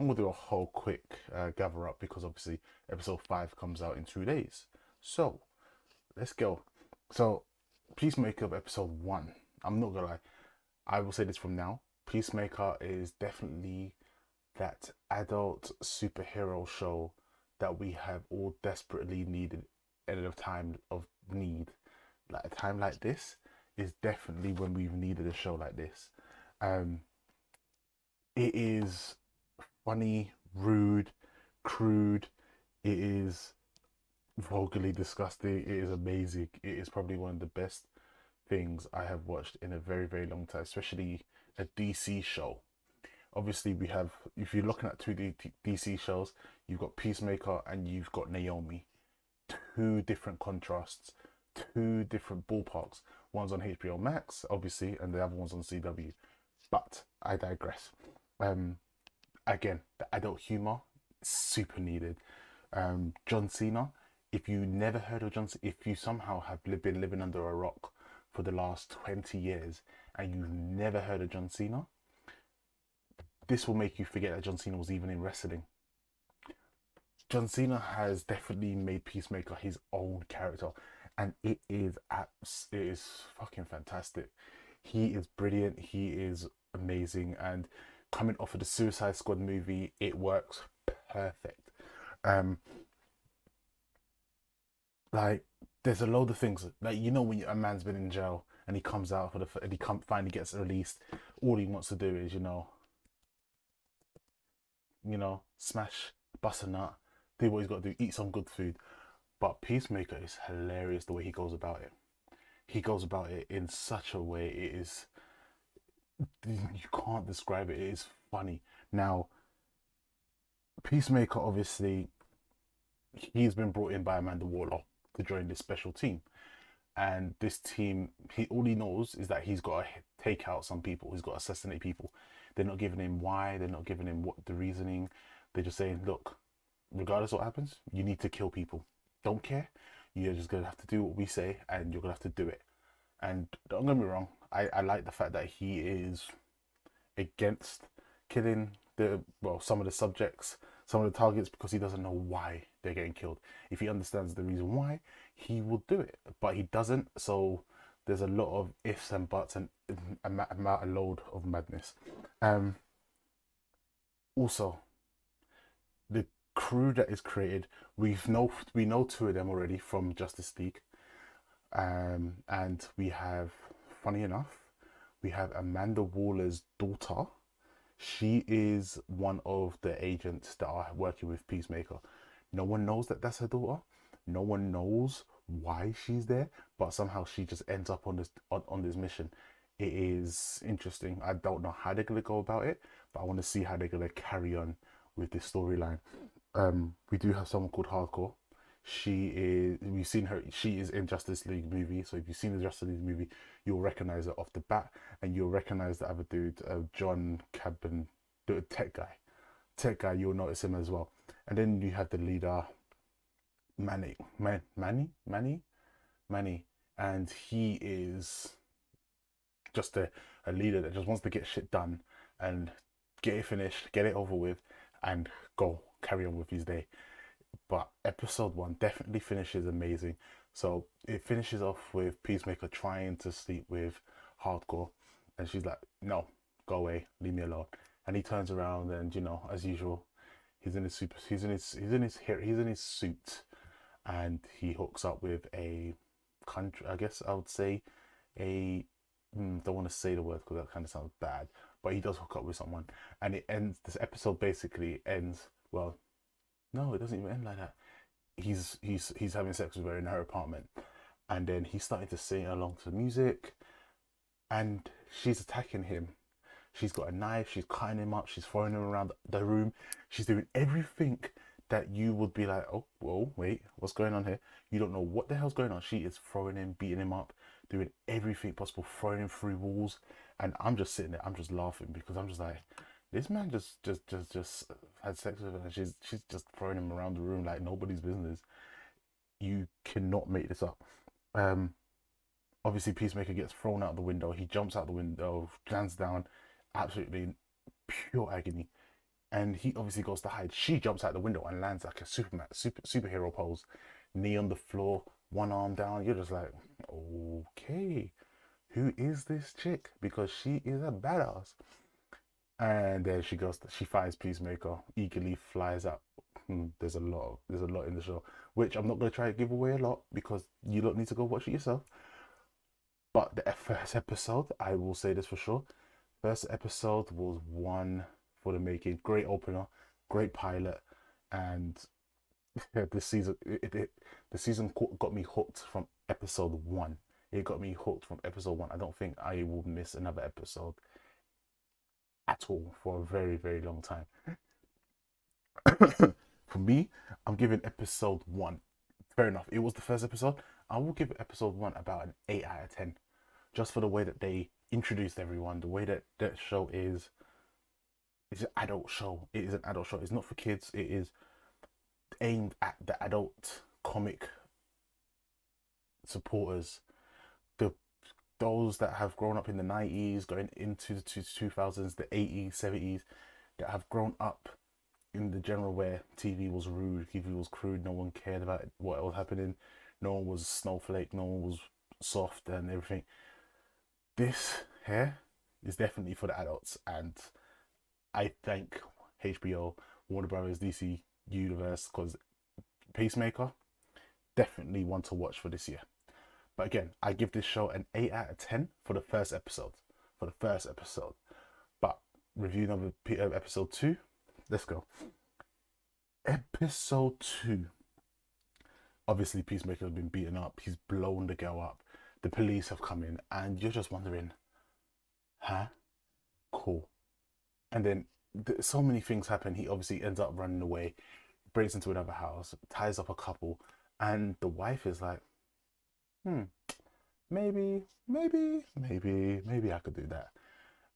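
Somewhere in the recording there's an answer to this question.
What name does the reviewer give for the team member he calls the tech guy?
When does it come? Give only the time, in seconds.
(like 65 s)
206 s.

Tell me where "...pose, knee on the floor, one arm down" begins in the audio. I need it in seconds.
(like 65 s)
303 s.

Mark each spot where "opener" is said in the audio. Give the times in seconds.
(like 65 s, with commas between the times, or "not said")
329 s.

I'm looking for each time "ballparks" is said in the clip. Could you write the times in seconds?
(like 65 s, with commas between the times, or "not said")
52 s.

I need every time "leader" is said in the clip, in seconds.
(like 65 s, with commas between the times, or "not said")
212 s, 220 s.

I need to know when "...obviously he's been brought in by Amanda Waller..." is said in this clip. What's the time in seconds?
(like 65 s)
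121 s.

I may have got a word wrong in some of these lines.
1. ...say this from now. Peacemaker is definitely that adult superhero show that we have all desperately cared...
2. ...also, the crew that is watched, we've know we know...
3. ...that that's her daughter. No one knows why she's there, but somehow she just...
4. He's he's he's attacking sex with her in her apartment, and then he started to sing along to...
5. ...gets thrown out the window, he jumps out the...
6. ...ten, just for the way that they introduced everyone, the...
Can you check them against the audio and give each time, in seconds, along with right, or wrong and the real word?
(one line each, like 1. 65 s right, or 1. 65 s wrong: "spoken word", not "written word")
1. 11 s wrong: "needed", not "cared"
2. 164 s wrong: "created", not "watched"
3. 183 s right
4. 258 s wrong: "having", not "attacking"
5. 293 s right
6. 352 s right.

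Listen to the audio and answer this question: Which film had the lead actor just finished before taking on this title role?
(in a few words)
Suicide Squad.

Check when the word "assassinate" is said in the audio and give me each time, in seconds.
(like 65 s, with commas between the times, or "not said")
131 s.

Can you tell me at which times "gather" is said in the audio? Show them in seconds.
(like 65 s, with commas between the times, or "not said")
1 s.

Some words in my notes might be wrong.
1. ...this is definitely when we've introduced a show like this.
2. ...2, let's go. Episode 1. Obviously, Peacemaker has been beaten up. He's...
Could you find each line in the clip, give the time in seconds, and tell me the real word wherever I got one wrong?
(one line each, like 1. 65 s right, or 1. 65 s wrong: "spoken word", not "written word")
1. 23 s wrong: "needed", not "introduced"
2. 403 s wrong: "2", not "1".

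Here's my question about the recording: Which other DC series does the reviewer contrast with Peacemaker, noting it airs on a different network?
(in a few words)
Naomi.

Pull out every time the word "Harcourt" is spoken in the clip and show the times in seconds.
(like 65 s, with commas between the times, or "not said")
197 s, 234 s.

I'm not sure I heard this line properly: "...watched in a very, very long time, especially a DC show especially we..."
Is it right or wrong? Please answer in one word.
wrong.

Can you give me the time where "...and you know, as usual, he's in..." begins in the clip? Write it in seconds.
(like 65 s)
238 s.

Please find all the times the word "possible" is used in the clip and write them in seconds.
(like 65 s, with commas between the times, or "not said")
278 s.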